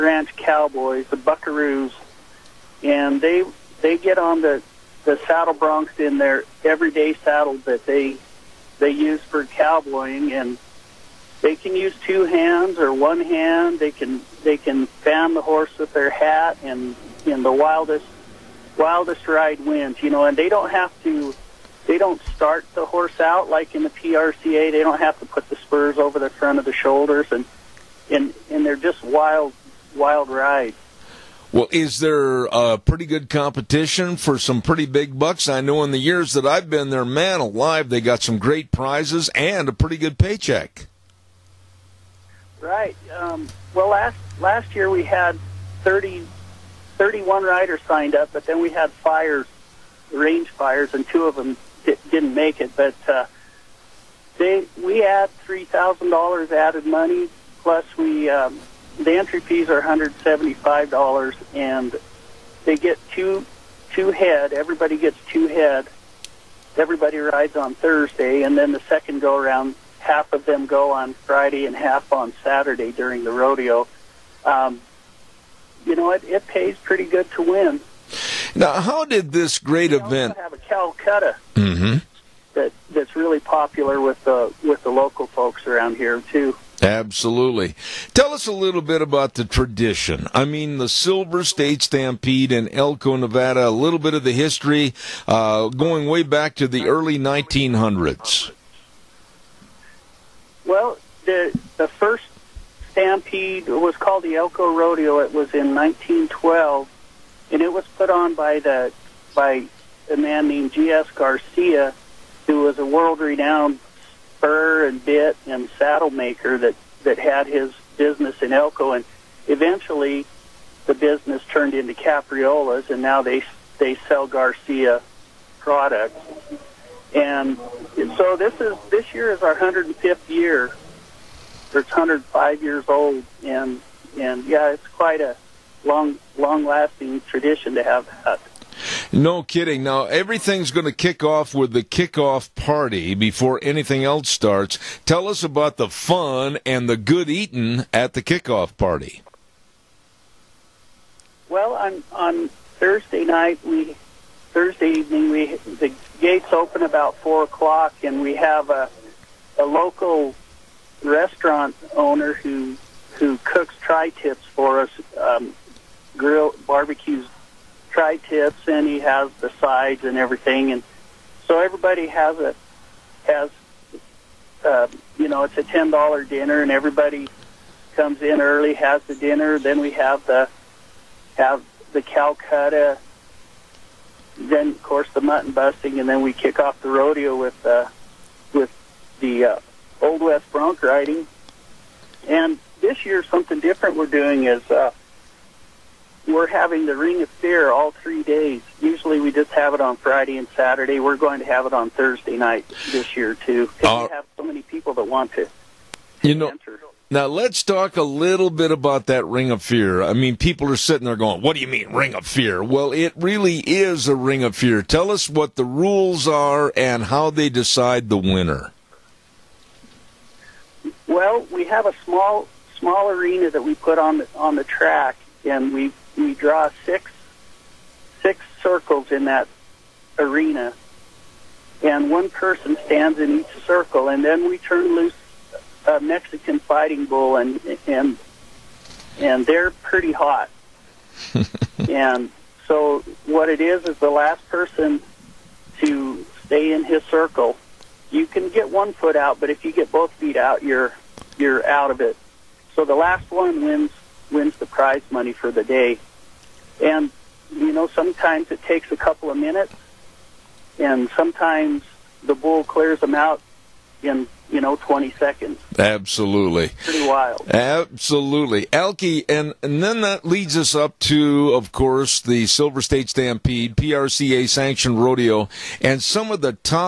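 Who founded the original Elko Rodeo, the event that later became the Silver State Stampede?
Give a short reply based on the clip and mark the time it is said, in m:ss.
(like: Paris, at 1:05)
G.S. Garcia, at 1:50.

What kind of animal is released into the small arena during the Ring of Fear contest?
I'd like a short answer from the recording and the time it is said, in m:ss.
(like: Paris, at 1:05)
Mexican fighting bull, at 3:56.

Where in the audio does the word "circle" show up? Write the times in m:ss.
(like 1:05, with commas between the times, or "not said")
3:48, 3:53, 4:07.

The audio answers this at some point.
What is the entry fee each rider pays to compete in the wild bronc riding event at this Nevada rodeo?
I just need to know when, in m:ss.
0:59.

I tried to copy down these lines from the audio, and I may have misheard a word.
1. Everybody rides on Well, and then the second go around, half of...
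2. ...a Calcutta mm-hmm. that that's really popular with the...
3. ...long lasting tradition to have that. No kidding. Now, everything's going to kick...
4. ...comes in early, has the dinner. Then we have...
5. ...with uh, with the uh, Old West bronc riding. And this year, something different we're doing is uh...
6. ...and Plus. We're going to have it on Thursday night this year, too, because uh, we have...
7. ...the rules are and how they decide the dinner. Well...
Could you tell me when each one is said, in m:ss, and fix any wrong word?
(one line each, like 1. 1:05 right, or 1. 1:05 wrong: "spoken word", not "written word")
1. 1:06 wrong: "Thursday", not "Well"
2. 1:20 right
3. 2:16 right
4. 2:57 right
5. 3:07 right
6. 3:20 wrong: "Saturday", not "Plus"
7. 3:35 wrong: "winner", not "dinner".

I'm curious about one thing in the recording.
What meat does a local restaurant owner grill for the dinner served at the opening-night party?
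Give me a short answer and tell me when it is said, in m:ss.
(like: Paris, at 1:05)
Tri-tips, at 2:43.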